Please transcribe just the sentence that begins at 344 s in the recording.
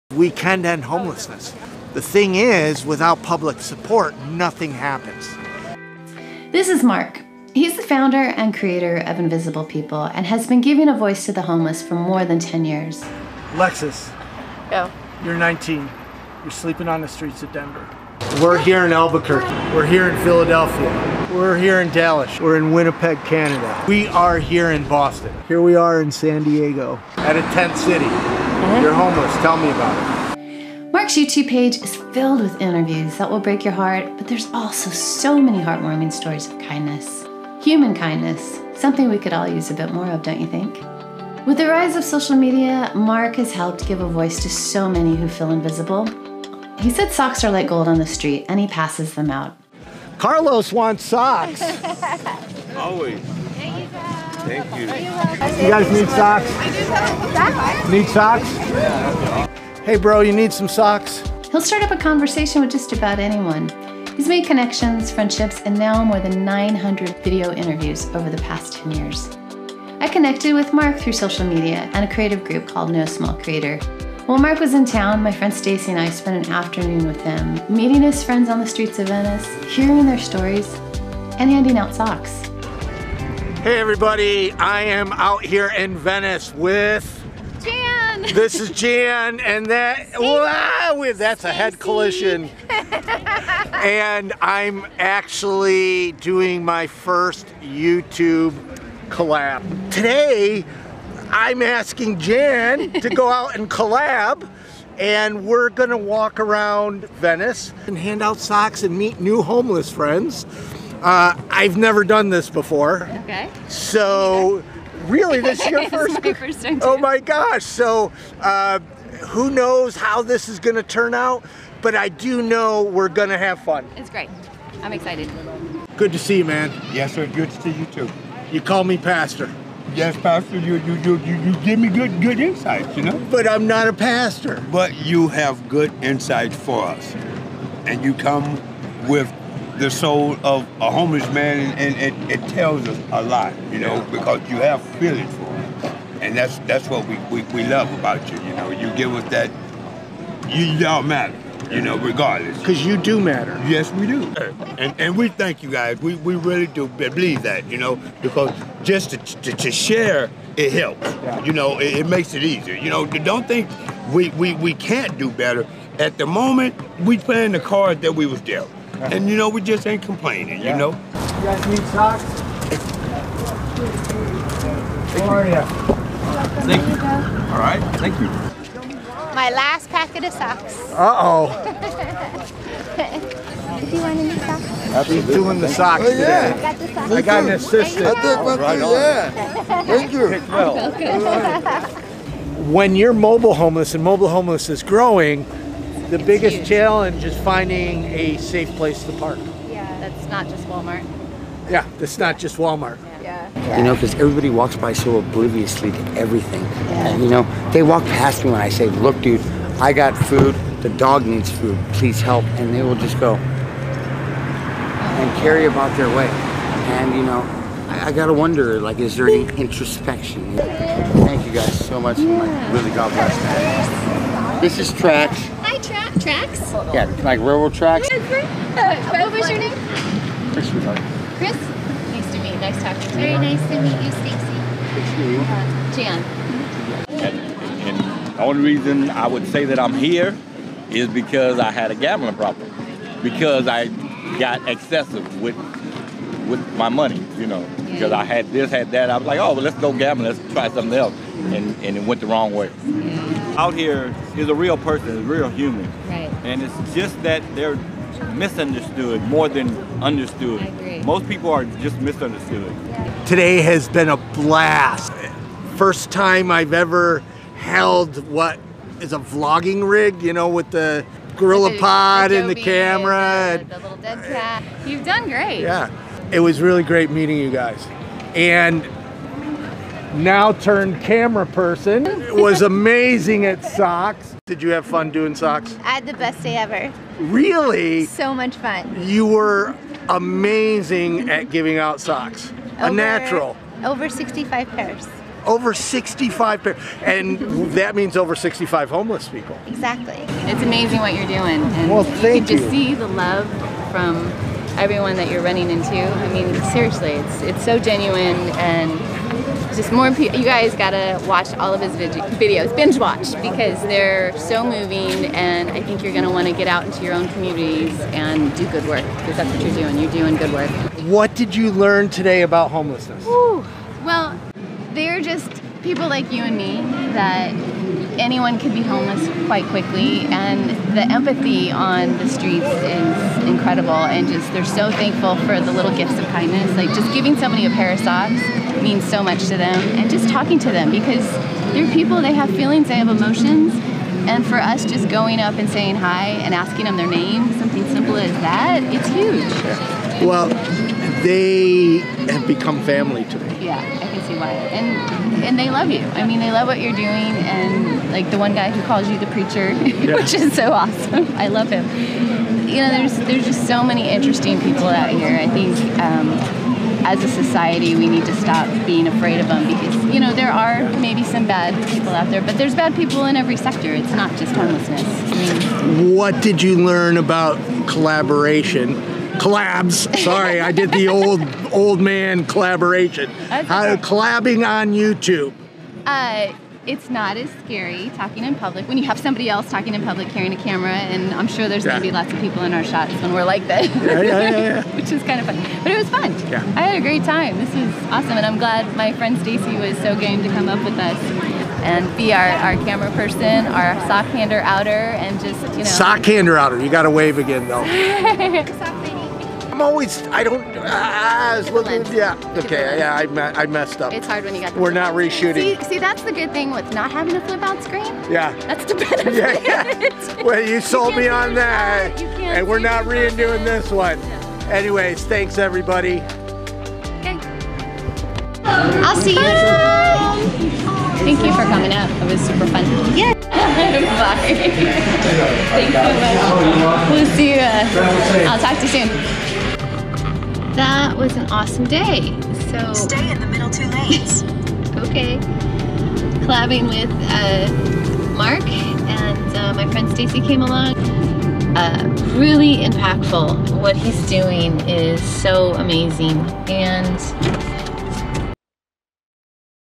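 And for us, just going up and saying hi and asking them their name, something simple as that, it's huge.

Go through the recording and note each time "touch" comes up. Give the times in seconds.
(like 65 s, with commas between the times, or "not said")
not said.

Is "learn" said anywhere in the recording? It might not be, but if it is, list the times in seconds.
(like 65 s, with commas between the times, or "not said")
321 s, 376 s.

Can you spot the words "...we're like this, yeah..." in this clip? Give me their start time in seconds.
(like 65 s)
393 s.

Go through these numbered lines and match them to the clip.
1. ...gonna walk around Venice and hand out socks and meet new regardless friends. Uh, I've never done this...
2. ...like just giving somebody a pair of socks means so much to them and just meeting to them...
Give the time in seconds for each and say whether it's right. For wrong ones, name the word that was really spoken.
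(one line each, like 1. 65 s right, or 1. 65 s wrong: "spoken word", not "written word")
1. 105 s wrong: "homeless", not "regardless"
2. 336 s wrong: "talking", not "meeting".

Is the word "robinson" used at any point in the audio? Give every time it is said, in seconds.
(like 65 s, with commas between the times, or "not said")
not said.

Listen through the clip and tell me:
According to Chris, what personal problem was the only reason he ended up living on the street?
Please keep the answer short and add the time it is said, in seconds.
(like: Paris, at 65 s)
gambling problem, at 241 s.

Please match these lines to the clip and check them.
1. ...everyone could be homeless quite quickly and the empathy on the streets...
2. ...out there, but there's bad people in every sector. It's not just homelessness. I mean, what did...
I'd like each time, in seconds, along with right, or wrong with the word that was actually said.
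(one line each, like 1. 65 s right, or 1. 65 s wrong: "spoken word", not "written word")
1. 328 s wrong: "anyone", not "everyone"
2. 372 s right.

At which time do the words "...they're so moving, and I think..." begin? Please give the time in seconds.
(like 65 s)
313 s.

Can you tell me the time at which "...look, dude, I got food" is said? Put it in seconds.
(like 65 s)
208 s.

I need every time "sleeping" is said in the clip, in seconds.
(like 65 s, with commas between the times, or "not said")
16 s.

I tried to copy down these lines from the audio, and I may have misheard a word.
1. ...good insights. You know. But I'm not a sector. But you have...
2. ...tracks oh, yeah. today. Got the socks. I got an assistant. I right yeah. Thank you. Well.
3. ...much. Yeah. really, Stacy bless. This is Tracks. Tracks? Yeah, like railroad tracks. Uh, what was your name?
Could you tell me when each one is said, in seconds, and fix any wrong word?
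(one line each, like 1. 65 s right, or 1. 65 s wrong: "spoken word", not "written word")
1. 132 s wrong: "pastor", not "sector"
2. 185 s wrong: "socks", not "tracks"
3. 222 s wrong: "God", not "Stacy".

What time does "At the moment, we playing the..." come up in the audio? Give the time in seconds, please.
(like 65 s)
165 s.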